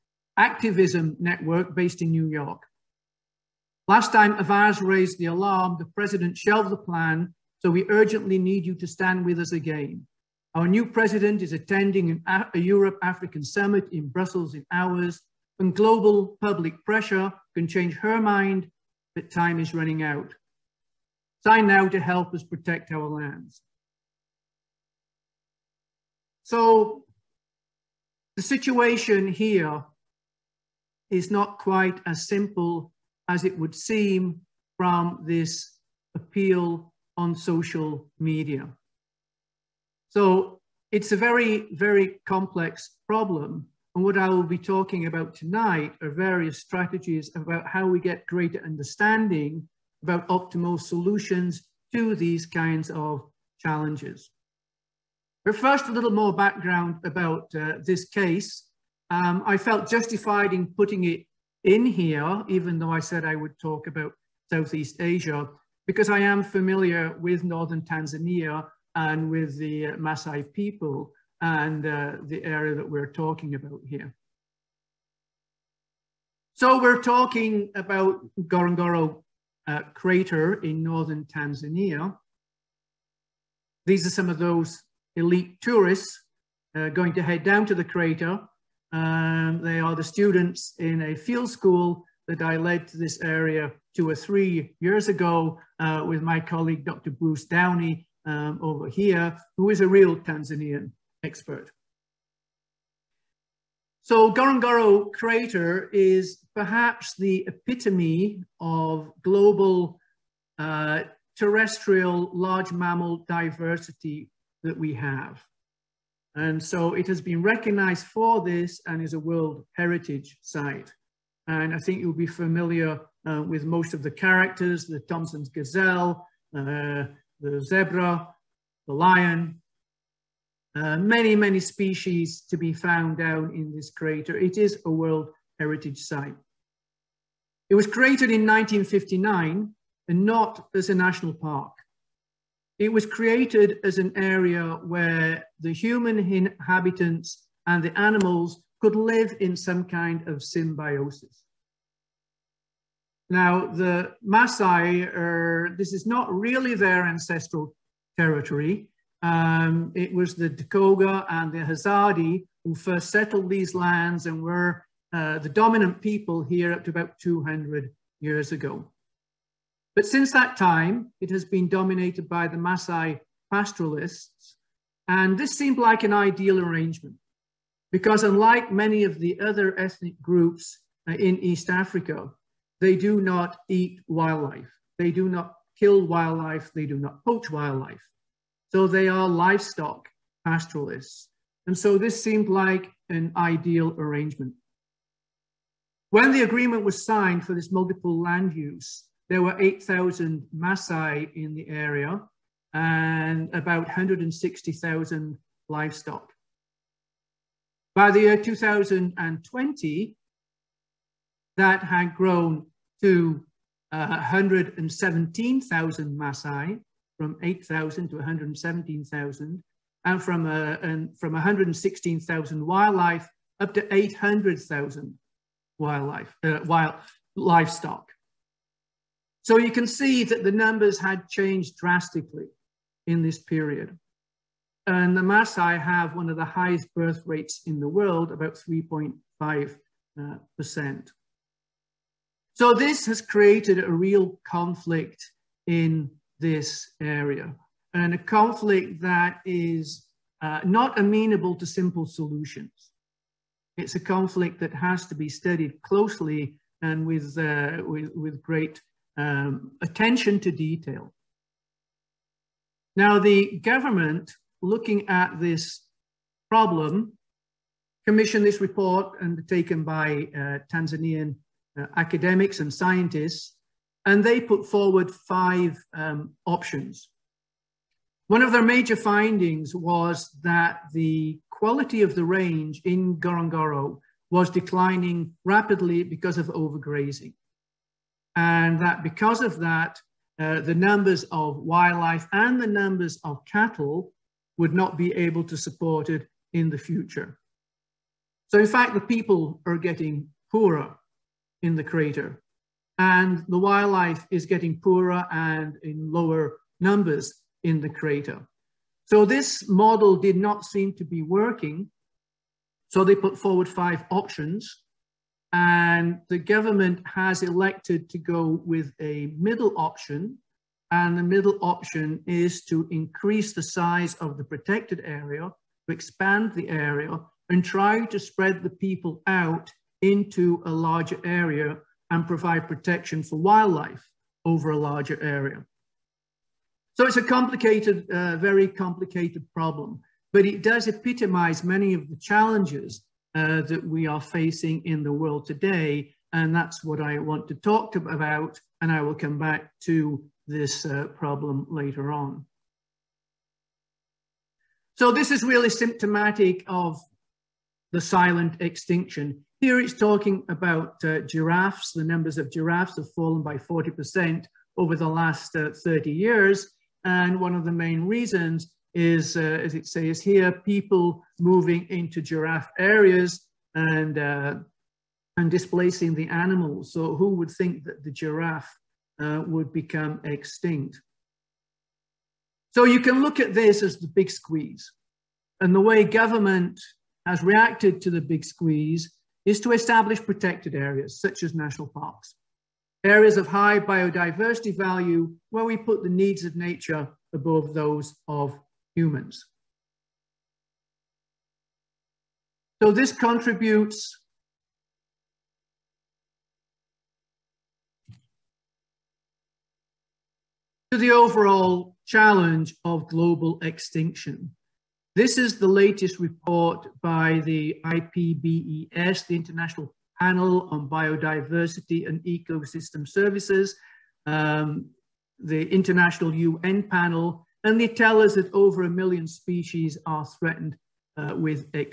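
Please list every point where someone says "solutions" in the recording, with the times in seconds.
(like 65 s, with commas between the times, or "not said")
50 s, 252 s.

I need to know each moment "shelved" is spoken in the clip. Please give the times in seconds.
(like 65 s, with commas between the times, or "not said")
6 s.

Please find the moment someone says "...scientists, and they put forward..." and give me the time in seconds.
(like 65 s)
272 s.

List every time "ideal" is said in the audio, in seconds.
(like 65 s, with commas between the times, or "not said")
176 s, 193 s.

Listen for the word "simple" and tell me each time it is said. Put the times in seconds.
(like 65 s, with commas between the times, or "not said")
32 s, 251 s.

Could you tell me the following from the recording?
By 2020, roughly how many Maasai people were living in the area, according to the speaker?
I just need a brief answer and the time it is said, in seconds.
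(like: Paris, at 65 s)
117,000, at 214 s.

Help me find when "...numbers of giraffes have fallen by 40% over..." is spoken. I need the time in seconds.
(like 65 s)
362 s.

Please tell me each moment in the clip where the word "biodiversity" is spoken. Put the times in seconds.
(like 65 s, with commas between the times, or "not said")
393 s, 420 s.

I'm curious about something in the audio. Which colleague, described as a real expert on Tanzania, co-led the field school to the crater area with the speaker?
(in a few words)
Dr. Bruce Downey.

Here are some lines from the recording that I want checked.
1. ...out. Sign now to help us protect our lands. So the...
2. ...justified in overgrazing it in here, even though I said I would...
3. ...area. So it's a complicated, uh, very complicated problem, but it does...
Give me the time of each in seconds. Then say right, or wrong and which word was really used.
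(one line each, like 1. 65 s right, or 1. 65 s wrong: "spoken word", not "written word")
1. 20 s right
2. 59 s wrong: "putting", not "overgrazing"
3. 335 s right.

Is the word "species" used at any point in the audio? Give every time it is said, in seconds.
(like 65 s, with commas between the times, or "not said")
131 s, 429 s.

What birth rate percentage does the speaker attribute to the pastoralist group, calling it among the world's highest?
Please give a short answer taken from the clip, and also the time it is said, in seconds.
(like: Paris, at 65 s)
3.5%, at 238 s.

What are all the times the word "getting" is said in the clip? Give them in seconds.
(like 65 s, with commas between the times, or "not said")
299 s, 304 s.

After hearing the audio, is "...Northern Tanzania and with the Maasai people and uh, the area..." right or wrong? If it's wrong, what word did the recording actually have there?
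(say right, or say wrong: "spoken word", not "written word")
right.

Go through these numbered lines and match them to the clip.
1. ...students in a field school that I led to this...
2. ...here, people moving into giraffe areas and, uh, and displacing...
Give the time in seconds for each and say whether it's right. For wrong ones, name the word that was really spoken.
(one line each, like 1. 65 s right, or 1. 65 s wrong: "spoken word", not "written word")
1. 90 s right
2. 370 s right.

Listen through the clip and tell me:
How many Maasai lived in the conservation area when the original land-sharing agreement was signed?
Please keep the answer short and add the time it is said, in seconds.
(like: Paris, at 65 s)
8,000, at 199 s.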